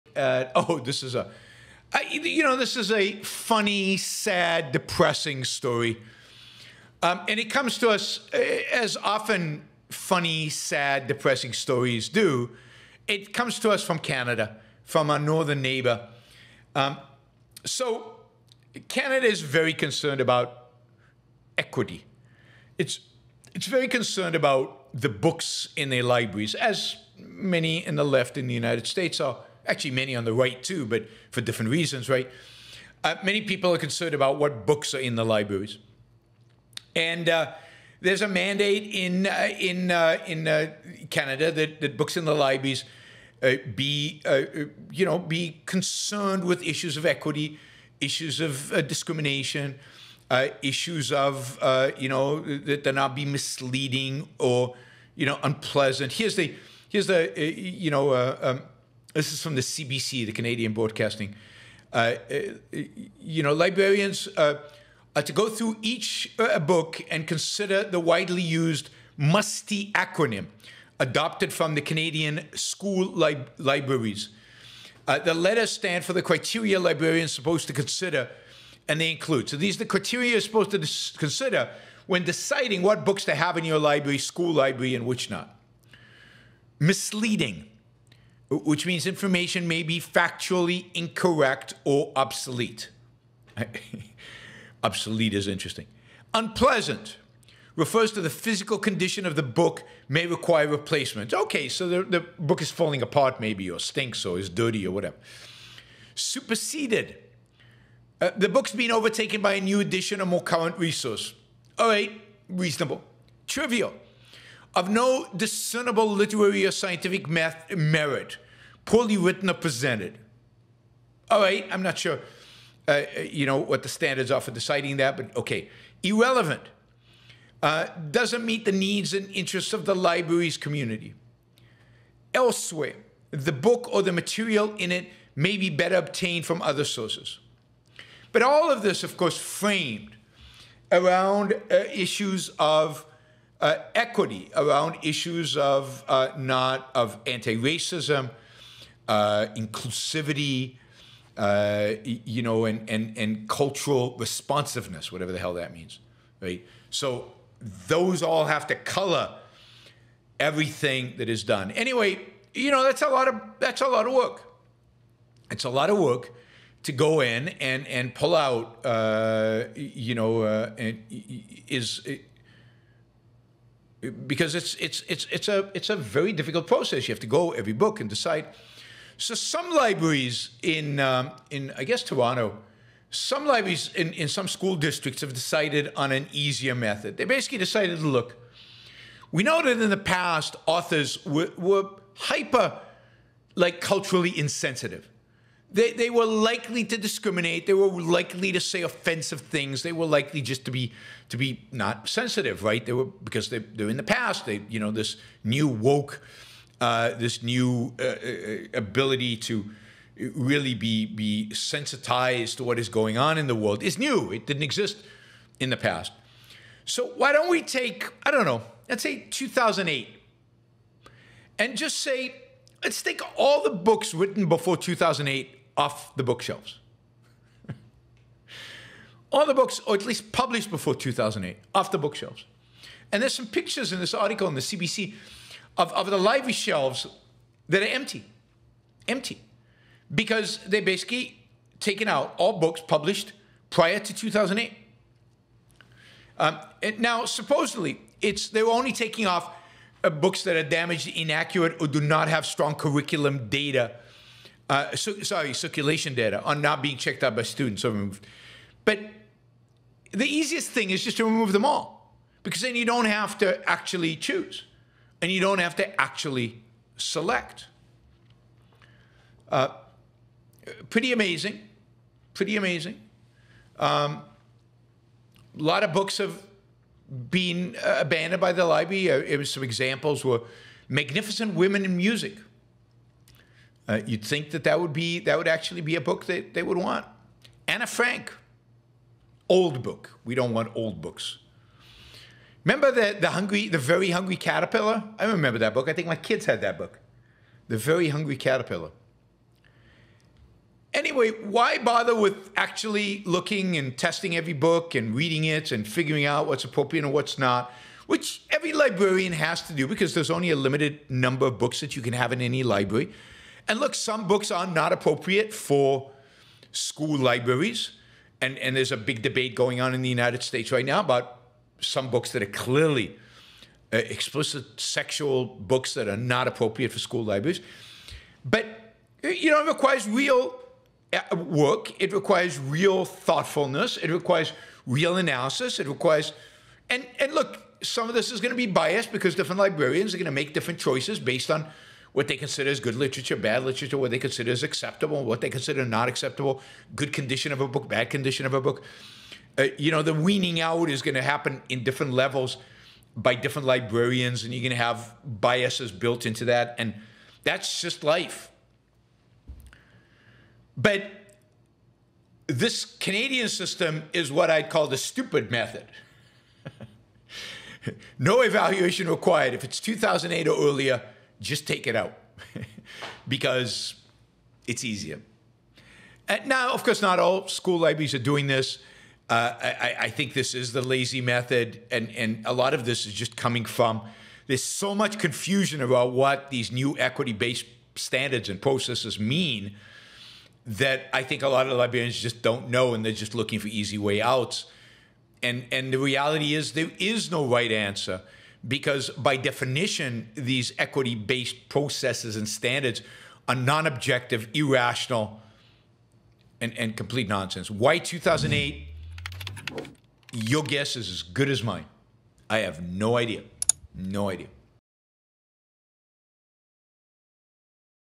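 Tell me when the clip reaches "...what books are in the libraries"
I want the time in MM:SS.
00:34.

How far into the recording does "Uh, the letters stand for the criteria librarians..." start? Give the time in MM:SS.
01:15.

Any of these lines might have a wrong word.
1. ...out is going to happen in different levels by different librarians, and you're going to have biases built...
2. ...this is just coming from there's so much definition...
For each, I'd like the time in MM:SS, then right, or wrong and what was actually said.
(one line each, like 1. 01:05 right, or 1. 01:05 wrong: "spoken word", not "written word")
1. 05:50 right
2. 06:22 wrong: "confusion", not "definition".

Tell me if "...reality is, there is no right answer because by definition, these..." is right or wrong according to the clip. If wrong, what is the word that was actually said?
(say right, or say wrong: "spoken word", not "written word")
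right.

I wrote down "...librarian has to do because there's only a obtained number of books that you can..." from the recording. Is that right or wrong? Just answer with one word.
wrong.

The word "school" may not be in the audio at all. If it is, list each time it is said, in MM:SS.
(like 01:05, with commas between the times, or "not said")
01:12, 01:24, 03:04, 05:16, 05:26, 06:17.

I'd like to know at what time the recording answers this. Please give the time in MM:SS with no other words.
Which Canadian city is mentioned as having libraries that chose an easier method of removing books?
03:02.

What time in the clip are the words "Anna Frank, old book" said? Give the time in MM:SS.
04:47.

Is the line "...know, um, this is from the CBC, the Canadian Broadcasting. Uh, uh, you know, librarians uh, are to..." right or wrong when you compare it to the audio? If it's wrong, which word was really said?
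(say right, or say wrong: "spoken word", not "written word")
right.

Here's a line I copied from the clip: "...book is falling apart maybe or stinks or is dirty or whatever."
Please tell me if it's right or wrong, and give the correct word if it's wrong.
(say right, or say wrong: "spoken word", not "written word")
right.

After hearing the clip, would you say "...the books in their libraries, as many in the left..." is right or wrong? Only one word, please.
right.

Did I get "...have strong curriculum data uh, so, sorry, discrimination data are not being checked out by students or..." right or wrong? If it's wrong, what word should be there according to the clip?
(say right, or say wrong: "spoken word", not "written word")
wrong: "circulation", not "discrimination".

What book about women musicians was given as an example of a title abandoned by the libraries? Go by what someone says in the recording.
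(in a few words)
Magnificent Women in Music.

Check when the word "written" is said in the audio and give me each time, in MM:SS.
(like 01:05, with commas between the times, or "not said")
01:59, 03:44.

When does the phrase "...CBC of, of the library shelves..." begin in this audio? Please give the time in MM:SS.
03:54.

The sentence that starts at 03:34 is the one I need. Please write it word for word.
It didn't exist in the past.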